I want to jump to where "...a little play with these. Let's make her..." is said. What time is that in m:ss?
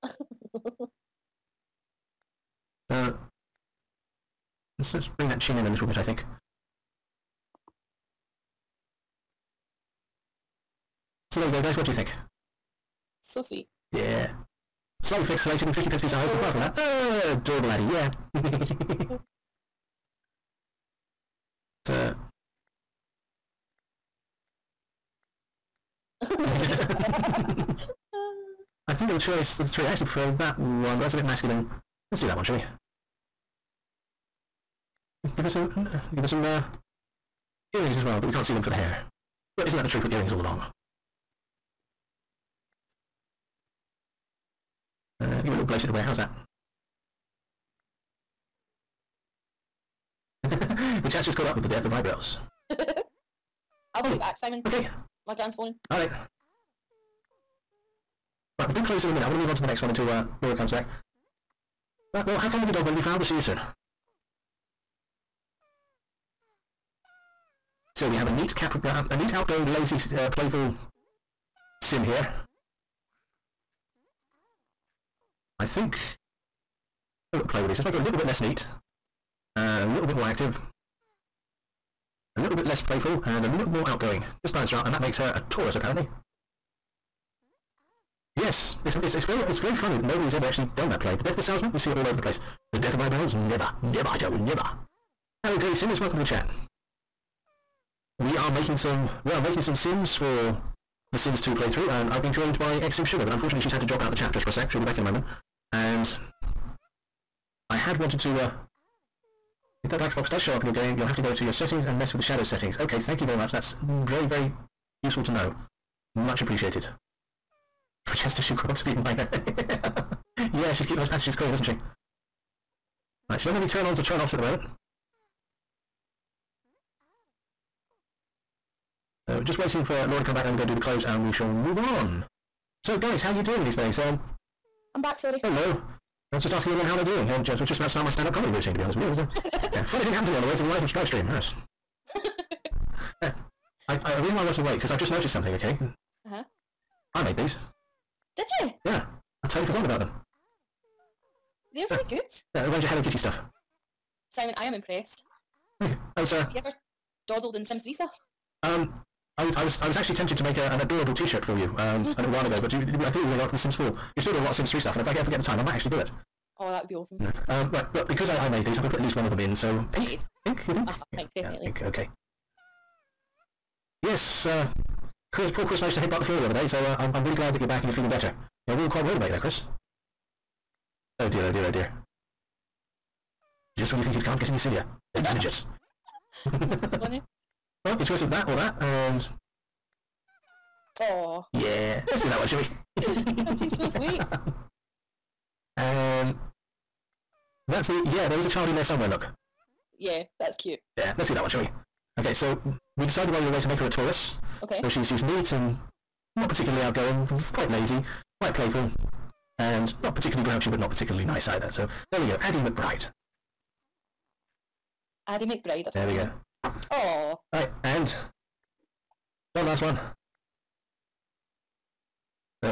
1:17.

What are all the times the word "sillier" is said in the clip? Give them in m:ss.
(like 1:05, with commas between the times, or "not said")
3:04.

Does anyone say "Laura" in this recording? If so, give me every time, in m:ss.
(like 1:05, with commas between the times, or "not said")
1:00, 2:10.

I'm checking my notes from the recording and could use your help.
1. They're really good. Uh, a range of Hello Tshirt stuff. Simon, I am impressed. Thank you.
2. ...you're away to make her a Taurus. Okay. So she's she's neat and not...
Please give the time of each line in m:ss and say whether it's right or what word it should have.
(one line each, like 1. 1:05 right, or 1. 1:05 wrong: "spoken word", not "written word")
1. 2:31 wrong: "Kitty", not "Tshirt"
2. 3:23 right.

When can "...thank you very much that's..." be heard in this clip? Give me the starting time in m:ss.
1:52.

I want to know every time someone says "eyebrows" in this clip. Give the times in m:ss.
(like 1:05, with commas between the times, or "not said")
0:51, 1:32.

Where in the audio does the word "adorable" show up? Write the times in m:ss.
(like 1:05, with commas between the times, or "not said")
0:17, 2:40.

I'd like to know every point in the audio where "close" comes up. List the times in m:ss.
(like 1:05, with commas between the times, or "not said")
0:58, 2:10.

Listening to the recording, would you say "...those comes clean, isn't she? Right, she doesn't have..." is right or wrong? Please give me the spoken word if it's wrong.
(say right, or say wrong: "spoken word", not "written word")
wrong: "passages", not "comes".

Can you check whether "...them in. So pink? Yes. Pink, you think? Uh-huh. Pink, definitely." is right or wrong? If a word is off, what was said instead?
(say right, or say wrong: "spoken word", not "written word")
right.